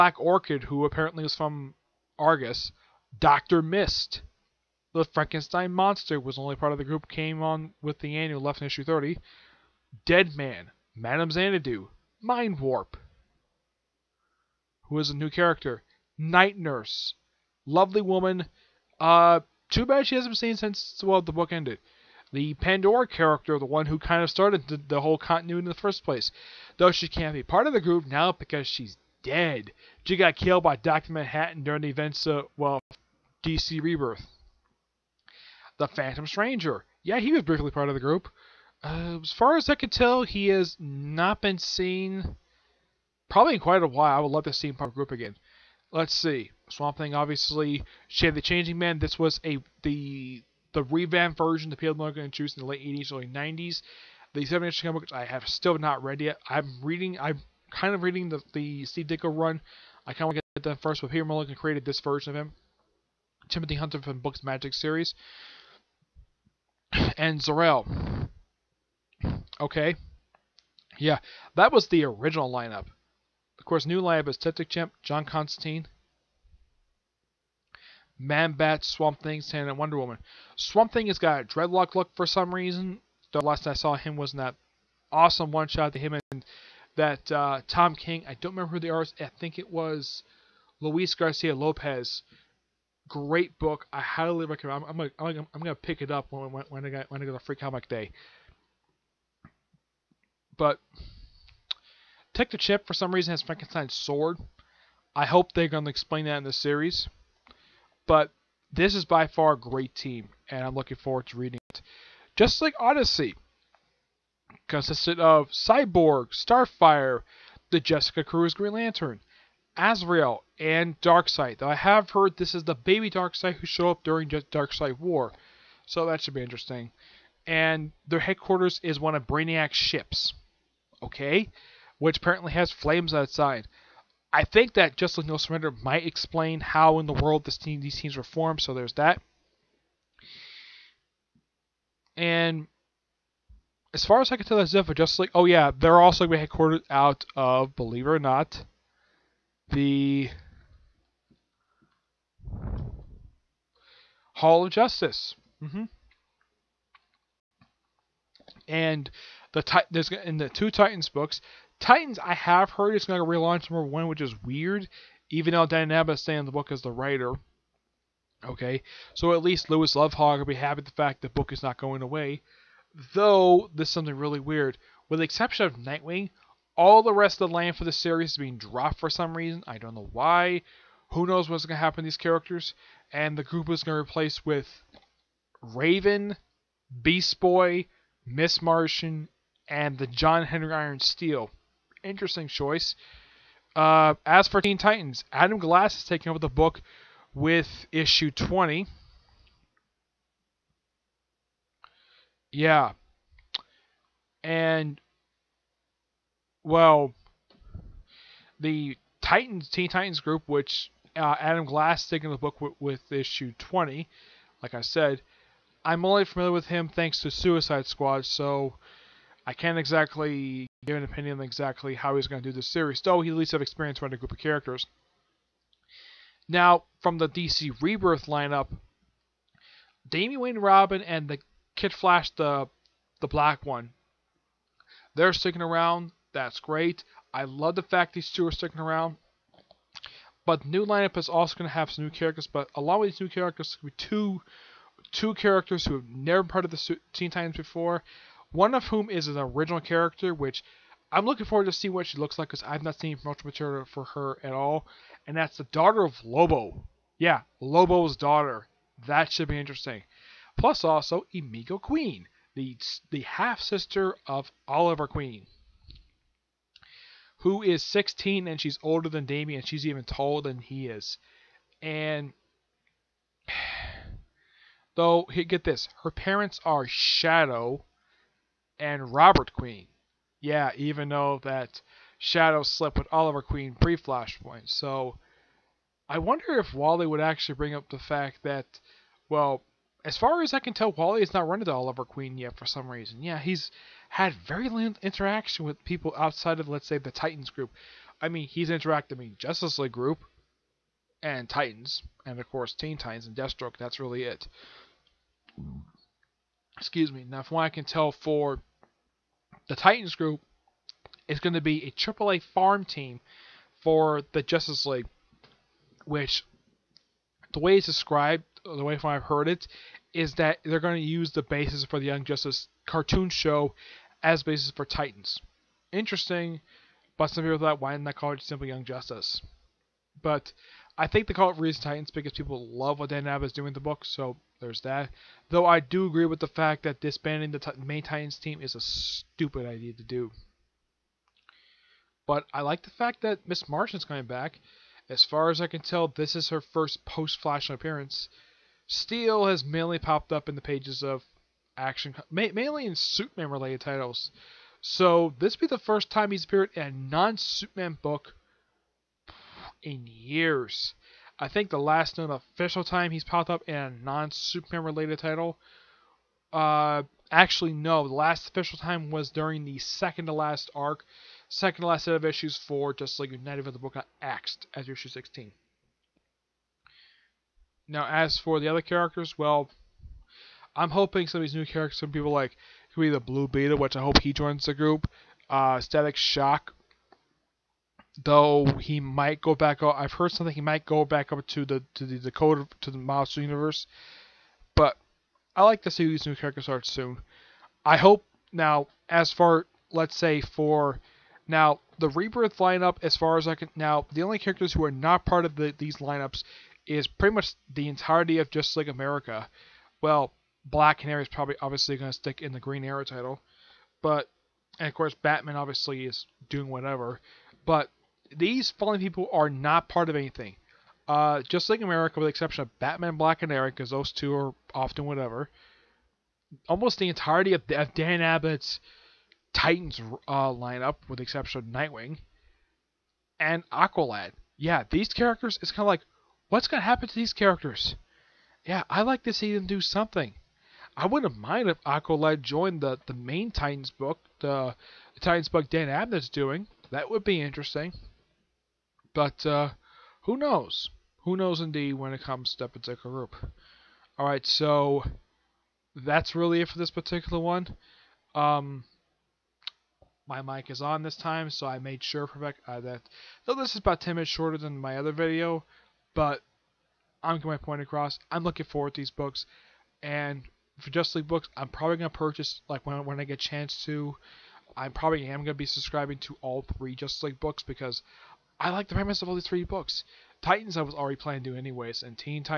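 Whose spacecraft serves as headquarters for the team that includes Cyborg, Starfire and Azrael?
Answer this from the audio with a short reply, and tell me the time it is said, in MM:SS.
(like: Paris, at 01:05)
Brainiac, at 02:09.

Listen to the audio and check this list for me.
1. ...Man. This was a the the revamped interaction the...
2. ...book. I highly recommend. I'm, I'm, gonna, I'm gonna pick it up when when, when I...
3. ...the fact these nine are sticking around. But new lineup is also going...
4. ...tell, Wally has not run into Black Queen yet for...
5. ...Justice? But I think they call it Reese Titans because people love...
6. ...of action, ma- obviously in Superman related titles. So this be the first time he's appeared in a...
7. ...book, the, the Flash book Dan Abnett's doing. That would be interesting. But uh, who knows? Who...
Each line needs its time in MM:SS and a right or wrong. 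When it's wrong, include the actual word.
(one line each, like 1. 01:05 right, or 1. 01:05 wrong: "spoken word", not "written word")
1. 00:48 wrong: "version", not "interaction"
2. 01:33 right
3. 03:57 wrong: "two", not "nine"
4. 04:50 wrong: "Oliver", not "Black"
5. 05:28 right
6. 05:51 wrong: "mainly", not "obviously"
7. 07:23 wrong: "Titans", not "Flash".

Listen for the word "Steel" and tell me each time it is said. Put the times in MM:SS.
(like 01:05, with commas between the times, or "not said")
03:11, 05:48.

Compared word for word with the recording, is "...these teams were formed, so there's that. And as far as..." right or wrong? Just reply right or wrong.
right.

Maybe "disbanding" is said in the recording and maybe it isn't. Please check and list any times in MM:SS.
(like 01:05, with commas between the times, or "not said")
05:37.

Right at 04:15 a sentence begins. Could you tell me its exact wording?
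And that's the daughter of Lobo.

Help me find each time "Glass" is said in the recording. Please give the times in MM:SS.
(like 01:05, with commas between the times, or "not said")
03:15, 03:31.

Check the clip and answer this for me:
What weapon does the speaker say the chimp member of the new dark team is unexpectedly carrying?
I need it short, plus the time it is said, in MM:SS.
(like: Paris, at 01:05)
Frankenstein's sword, at 01:43.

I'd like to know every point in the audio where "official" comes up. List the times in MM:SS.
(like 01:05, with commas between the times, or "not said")
06:02, 06:08.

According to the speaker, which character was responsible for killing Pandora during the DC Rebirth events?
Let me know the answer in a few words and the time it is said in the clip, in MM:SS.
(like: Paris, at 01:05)
Dr. Manhattan, at 00:30.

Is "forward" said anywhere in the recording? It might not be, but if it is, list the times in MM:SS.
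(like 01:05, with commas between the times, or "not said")
01:50, 04:11, 07:48.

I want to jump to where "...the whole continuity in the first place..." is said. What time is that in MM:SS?
00:24.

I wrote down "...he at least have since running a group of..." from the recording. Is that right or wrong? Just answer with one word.
wrong.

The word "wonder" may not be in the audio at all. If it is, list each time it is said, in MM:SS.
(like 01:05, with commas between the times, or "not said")
01:19, 04:46.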